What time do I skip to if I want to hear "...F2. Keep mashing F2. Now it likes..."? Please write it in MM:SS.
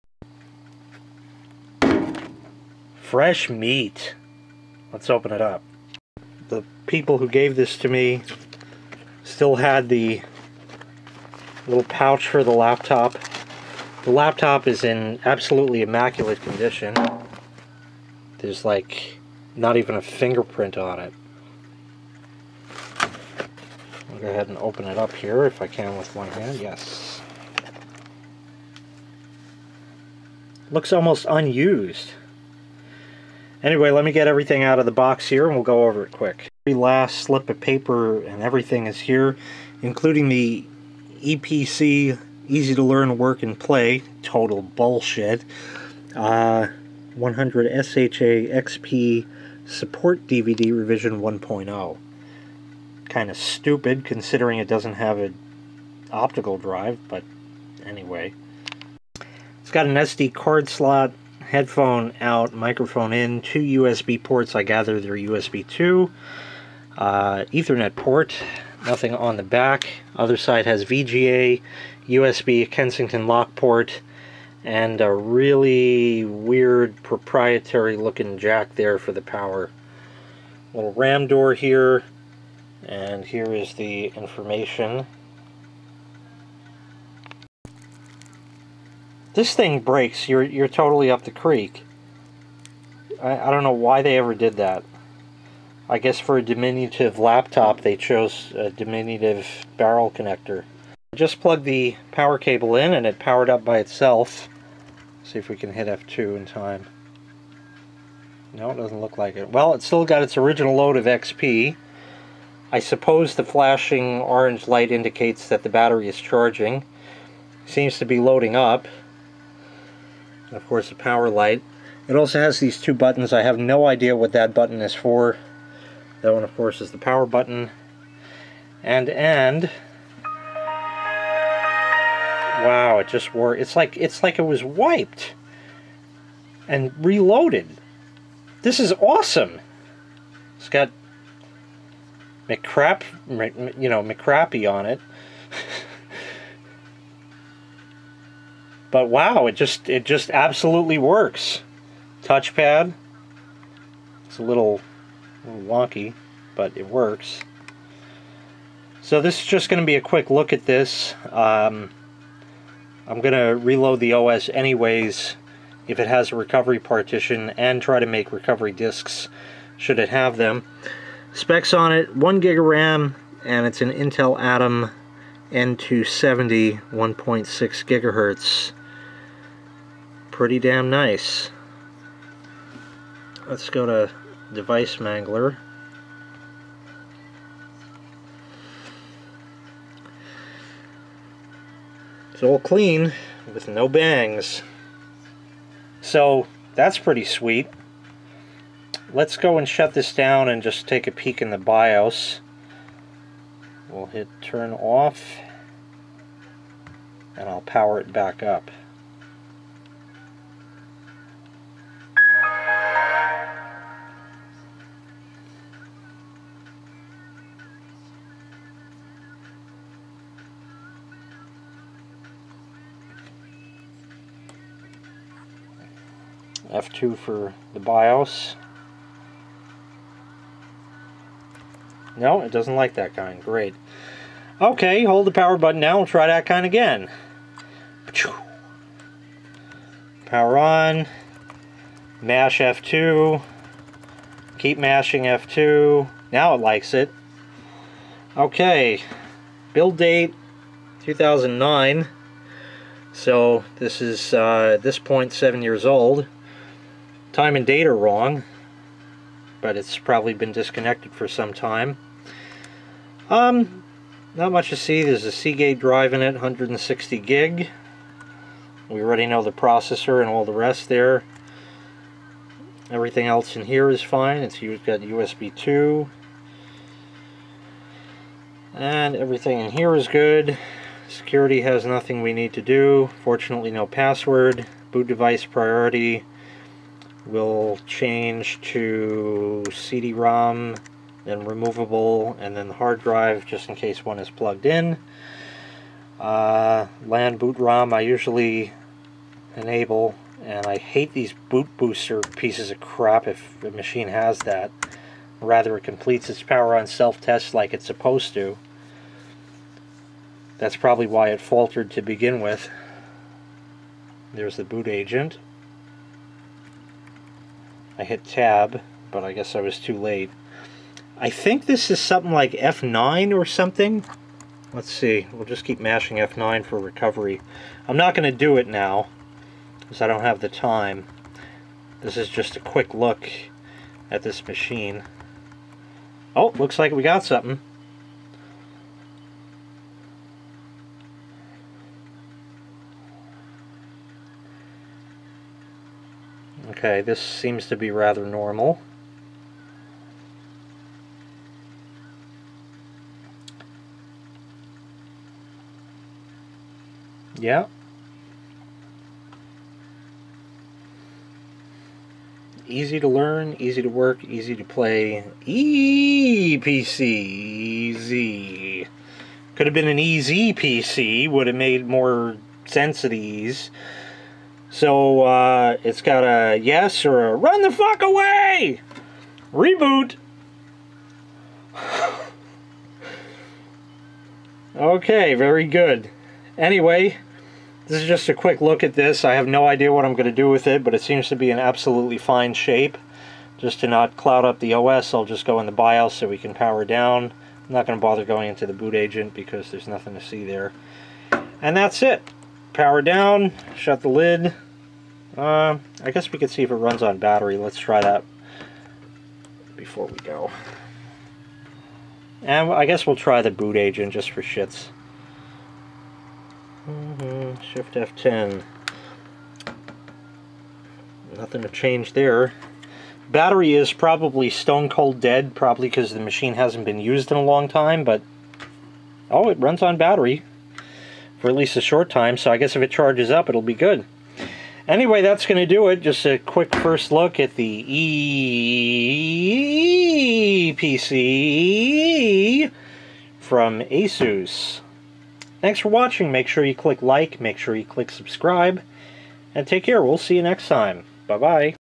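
04:02.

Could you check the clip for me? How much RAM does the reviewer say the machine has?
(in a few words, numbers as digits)
1 gig.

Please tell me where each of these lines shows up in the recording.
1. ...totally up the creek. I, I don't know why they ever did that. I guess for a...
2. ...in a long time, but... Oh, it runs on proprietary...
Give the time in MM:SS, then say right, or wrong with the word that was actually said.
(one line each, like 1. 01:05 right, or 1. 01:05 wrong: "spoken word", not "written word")
1. 01:30 right
2. 07:07 wrong: "battery", not "proprietary".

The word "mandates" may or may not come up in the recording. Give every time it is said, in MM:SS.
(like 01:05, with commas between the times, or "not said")
not said.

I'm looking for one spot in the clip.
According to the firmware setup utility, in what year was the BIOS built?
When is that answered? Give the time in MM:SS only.
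04:11.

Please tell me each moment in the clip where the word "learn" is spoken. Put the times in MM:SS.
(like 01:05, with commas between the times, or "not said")
00:42, 06:03.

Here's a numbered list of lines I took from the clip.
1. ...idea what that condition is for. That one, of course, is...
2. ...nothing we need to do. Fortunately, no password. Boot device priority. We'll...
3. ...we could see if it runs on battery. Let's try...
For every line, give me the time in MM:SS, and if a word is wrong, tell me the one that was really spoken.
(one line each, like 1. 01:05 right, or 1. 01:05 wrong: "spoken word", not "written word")
1. 02:03 wrong: "button", not "condition"
2. 04:41 right
3. 06:46 right.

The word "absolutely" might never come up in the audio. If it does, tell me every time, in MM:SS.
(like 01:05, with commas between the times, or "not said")
00:15, 02:30, 06:31.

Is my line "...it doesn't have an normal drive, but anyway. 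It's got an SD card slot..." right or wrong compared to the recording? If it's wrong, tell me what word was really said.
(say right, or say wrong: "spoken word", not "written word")
wrong: "optical", not "normal".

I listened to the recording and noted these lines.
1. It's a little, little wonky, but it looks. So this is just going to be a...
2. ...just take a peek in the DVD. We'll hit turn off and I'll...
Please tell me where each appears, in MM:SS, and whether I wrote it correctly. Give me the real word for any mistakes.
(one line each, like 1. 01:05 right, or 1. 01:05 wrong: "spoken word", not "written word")
1. 02:34 wrong: "works", not "looks"
2. 03:20 wrong: "BIOS", not "DVD".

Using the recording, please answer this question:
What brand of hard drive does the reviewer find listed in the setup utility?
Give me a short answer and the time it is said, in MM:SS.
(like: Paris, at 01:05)
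Seagate, at 04:25.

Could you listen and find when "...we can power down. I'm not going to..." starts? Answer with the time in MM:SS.
06:36.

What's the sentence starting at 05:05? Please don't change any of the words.
Rather, it completes its power on self-test like it's supposed to.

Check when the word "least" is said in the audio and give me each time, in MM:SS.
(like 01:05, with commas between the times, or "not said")
07:11.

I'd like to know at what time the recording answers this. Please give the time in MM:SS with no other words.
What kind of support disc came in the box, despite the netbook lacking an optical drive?
00:48.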